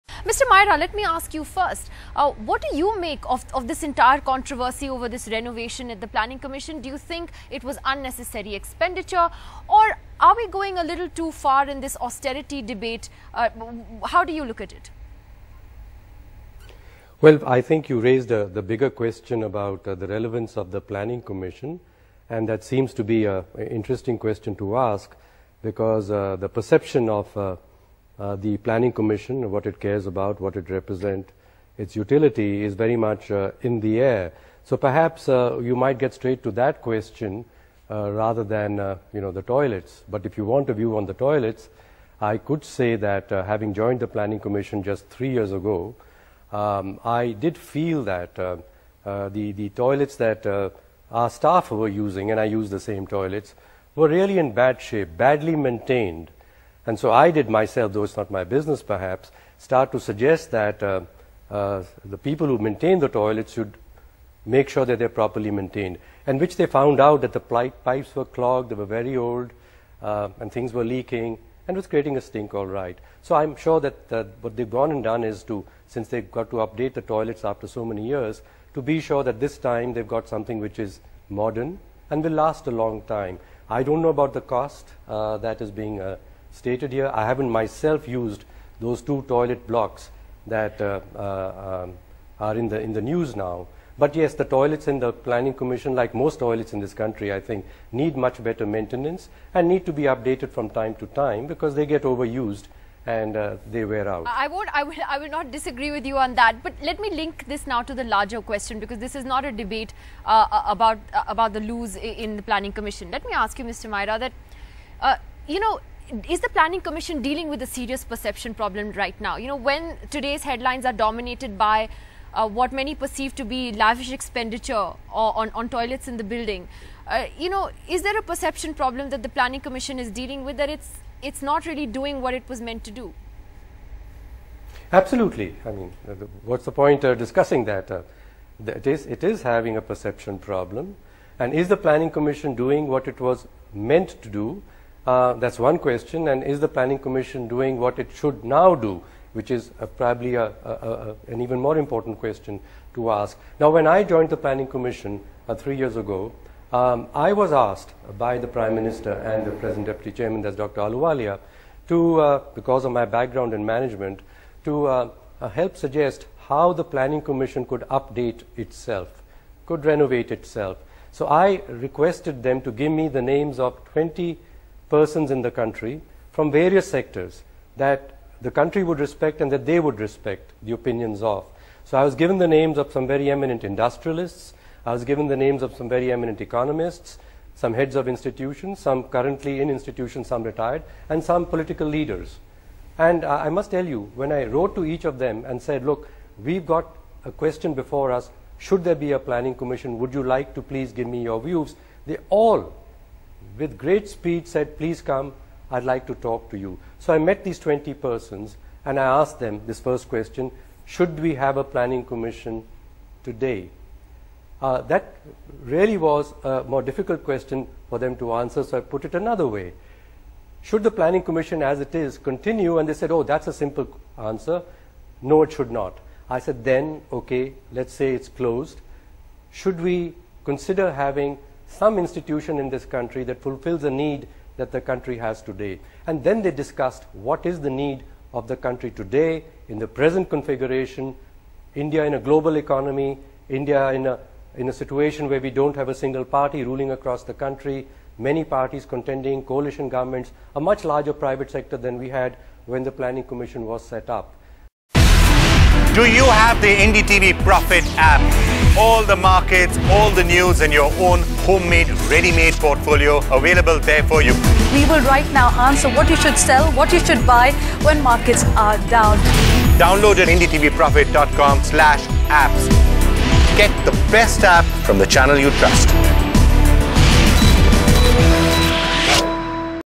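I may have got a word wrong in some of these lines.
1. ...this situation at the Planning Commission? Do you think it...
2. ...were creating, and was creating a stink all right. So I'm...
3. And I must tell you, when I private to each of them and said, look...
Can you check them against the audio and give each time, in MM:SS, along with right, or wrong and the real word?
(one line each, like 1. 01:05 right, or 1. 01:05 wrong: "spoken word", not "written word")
1. 00:05 wrong: "renovation", not "situation"
2. 01:10 wrong: "leaking", not "creating"
3. 03:12 wrong: "wrote", not "private".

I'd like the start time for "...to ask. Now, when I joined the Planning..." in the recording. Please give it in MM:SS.
02:32.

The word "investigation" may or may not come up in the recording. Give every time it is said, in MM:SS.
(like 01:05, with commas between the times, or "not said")
not said.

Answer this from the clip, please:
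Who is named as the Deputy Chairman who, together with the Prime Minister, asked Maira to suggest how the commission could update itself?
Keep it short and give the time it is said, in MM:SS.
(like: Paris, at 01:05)
Dr. Ahluwalia, at 02:40.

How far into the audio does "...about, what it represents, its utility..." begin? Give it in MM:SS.
00:30.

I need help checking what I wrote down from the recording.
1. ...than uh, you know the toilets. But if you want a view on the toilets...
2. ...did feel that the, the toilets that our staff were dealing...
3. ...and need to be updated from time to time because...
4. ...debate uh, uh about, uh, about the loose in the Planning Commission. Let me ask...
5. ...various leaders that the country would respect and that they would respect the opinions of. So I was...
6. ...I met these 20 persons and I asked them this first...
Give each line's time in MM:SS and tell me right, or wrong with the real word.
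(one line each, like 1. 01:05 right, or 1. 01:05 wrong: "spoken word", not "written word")
1. 00:38 right
2. 00:47 wrong: "using", not "dealing"
3. 01:39 right
4. 01:49 right
5. 02:56 wrong: "sectors", not "leaders"
6. 03:27 right.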